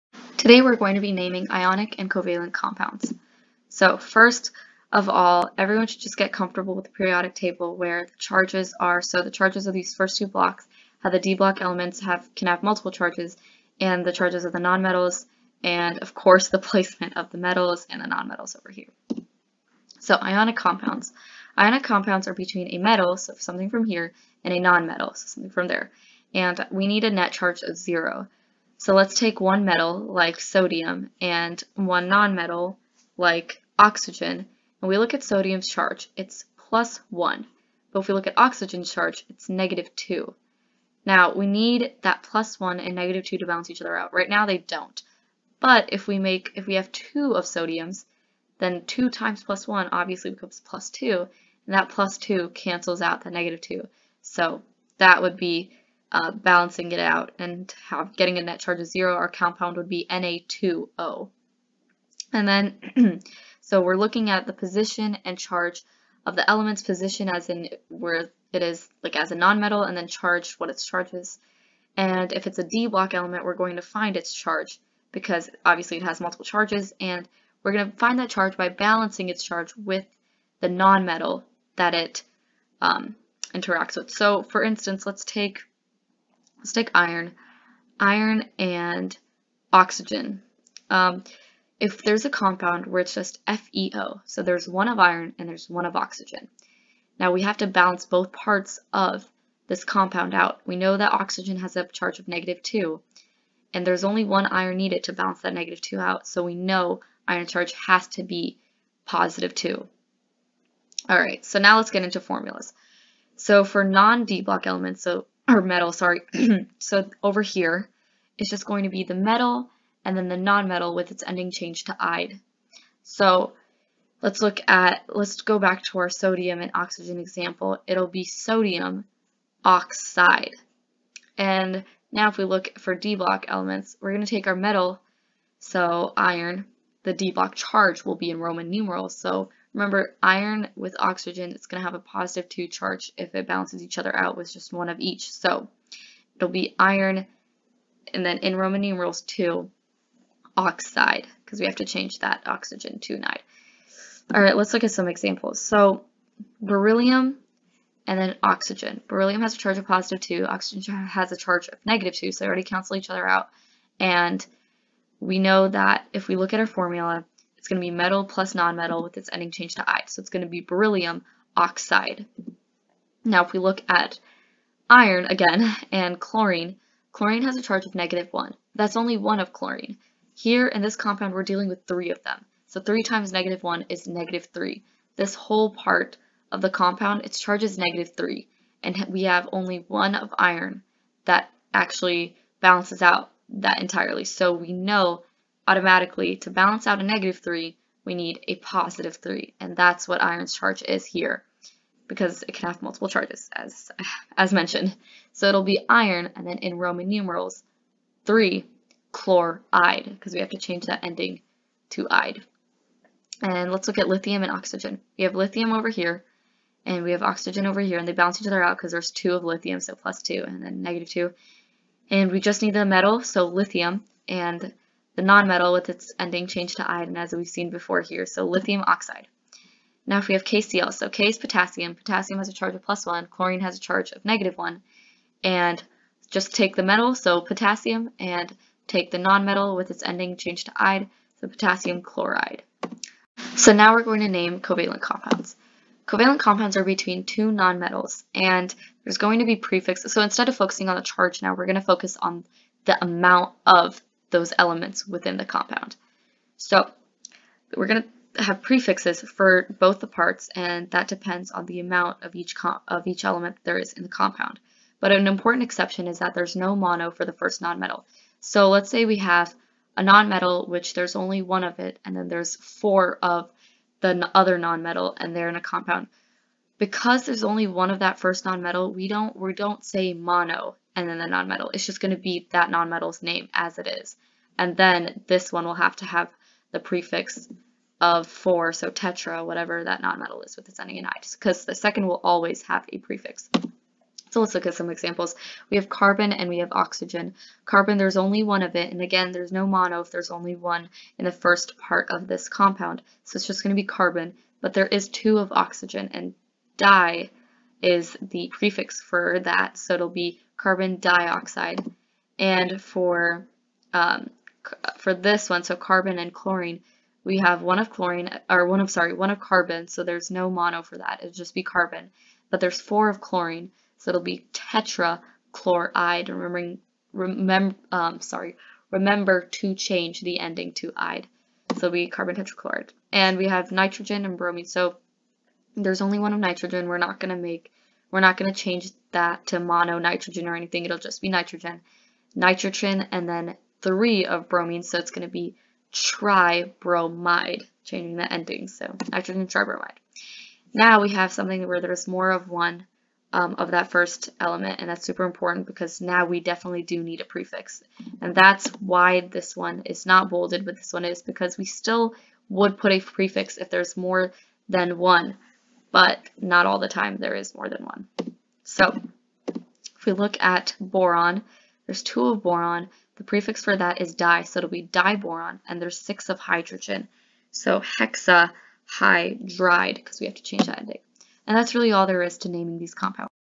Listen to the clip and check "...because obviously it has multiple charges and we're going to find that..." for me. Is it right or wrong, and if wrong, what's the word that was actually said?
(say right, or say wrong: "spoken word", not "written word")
right.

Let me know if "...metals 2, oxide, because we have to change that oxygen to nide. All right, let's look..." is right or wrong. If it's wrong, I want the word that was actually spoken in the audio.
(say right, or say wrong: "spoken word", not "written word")
wrong: "numerals", not "metals".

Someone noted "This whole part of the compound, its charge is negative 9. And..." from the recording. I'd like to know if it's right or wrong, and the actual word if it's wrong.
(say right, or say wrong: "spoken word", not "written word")
wrong: "3", not "9".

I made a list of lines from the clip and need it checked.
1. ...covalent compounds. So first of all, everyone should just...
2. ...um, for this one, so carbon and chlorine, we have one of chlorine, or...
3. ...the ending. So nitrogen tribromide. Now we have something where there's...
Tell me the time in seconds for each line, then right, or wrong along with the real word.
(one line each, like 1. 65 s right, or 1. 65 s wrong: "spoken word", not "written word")
1. 2 s right
2. 313 s right
3. 348 s right.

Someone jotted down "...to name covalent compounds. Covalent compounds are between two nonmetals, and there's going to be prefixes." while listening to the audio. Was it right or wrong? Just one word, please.
right.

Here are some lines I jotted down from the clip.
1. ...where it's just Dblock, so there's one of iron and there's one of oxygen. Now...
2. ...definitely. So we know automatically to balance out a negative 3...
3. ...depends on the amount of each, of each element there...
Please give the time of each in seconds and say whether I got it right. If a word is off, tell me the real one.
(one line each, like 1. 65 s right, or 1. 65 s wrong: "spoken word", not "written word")
1. 92 s wrong: "FeO", not "Dblock"
2. 193 s wrong: "entirely", not "definitely"
3. 261 s right.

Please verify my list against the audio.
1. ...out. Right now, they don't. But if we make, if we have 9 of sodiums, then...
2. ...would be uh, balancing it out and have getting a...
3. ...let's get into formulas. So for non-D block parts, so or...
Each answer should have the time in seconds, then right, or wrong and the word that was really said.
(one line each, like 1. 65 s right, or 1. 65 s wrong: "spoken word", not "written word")
1. 43 s wrong: "2", not "9"
2. 55 s right
3. 111 s wrong: "elements", not "parts".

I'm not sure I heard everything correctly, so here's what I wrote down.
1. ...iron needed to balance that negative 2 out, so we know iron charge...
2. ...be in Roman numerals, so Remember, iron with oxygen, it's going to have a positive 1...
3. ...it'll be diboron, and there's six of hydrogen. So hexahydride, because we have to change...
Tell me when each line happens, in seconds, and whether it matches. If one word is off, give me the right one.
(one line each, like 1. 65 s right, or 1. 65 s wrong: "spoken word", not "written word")
1. 104 s right
2. 138 s wrong: "2", not "1"
3. 374 s right.